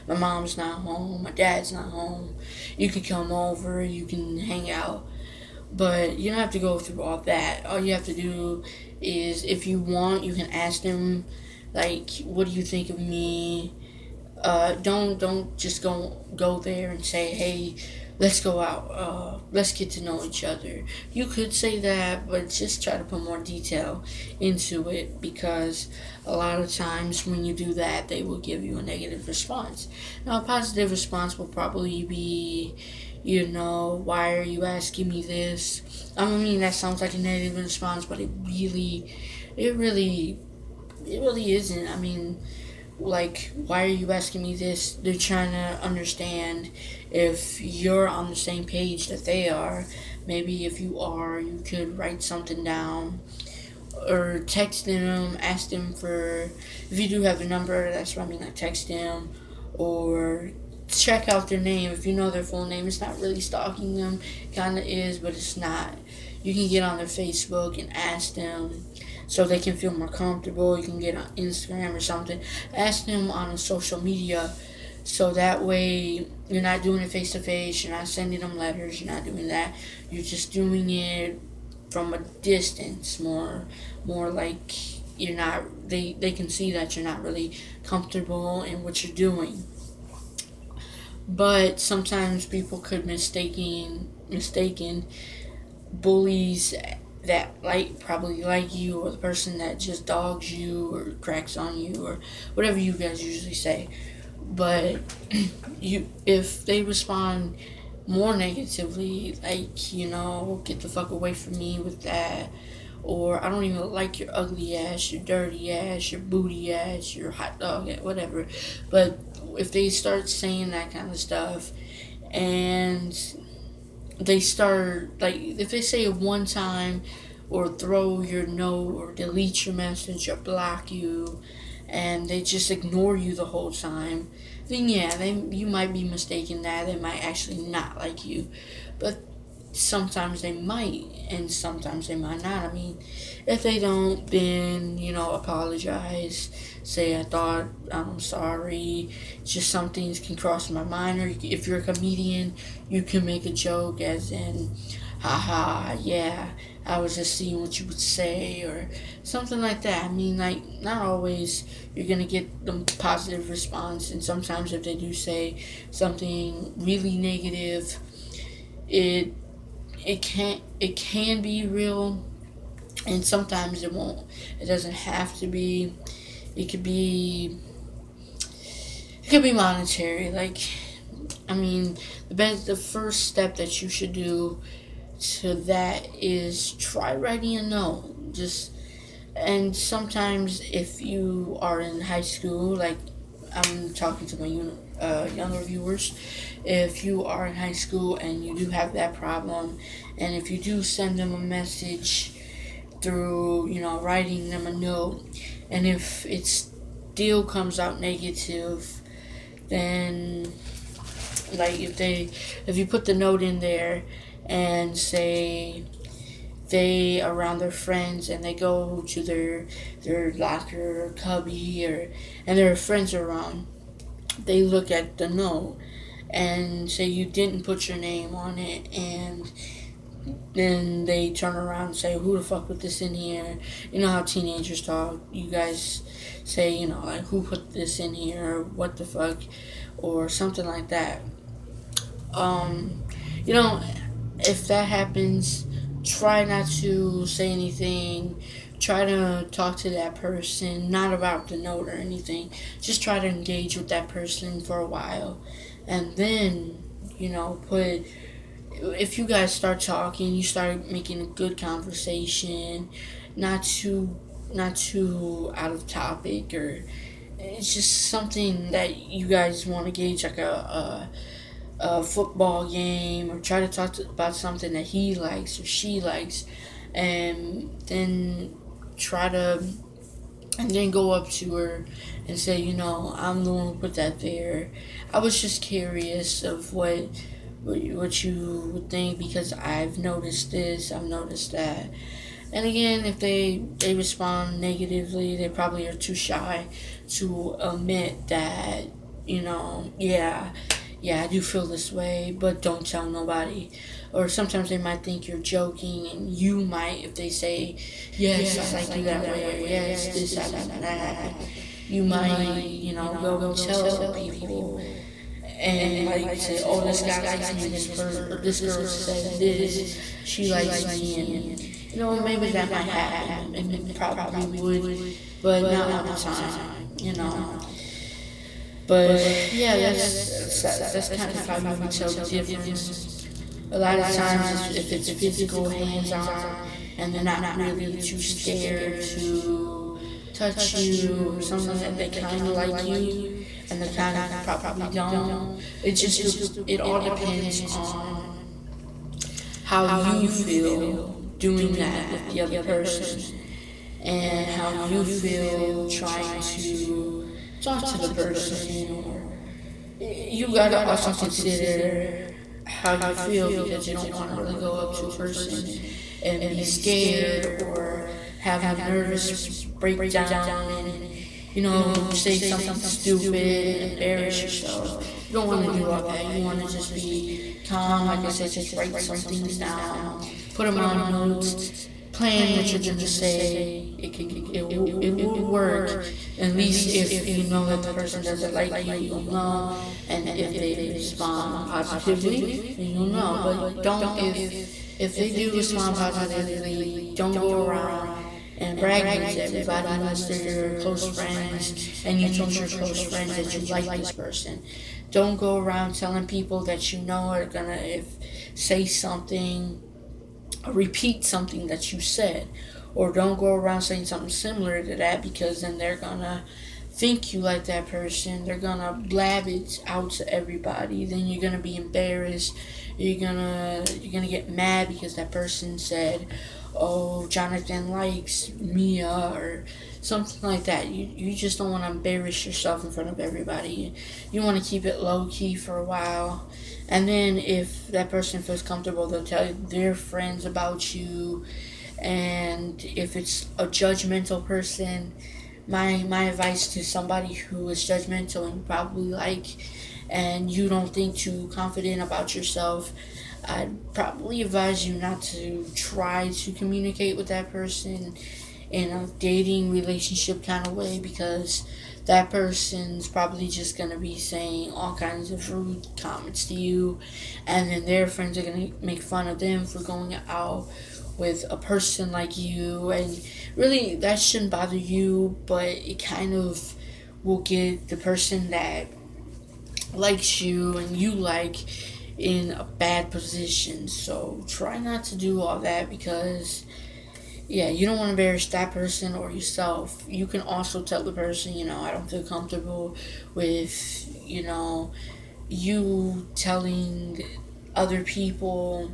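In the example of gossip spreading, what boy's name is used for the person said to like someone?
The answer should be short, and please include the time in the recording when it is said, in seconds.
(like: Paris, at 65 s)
Jonathan, at 427 s.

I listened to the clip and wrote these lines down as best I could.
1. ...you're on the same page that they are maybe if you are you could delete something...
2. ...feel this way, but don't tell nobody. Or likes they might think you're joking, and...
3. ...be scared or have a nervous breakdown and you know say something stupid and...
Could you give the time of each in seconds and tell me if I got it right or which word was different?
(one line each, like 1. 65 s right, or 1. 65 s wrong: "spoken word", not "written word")
1. 47 s wrong: "write", not "delete"
2. 301 s wrong: "sometimes", not "likes"
3. 366 s right.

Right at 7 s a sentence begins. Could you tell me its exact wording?
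All you have to do is if you want, you can ask them like what do you think of me?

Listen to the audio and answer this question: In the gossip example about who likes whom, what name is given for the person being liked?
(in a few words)
Mia.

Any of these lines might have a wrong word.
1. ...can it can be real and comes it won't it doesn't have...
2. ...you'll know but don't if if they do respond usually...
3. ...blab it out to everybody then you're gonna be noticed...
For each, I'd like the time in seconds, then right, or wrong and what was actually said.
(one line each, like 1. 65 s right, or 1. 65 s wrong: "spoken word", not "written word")
1. 170 s wrong: "sometimes", not "comes"
2. 392 s wrong: "positively", not "usually"
3. 419 s wrong: "embarrassed", not "noticed".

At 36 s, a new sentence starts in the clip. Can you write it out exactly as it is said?
I mean, that sounds like a negative response, but it really, it really, it really isn't.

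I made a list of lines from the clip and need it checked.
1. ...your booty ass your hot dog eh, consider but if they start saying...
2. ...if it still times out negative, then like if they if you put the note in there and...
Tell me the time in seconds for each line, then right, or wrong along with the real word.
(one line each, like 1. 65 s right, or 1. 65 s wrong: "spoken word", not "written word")
1. 116 s wrong: "whatever", not "consider"
2. 205 s wrong: "comes", not "times".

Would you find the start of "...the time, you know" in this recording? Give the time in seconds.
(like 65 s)
326 s.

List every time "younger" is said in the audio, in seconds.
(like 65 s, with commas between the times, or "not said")
195 s.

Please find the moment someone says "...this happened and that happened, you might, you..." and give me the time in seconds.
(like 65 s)
310 s.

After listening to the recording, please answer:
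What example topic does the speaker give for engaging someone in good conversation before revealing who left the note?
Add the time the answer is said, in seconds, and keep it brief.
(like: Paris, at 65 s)
a football game, at 272 s.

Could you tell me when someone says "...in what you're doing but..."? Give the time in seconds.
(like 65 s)
88 s.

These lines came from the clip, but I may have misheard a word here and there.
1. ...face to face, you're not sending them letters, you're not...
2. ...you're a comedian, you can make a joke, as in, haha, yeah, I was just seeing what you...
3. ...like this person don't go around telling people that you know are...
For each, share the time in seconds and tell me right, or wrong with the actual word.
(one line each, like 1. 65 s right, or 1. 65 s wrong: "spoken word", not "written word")
1. 77 s right
2. 151 s right
3. 403 s right.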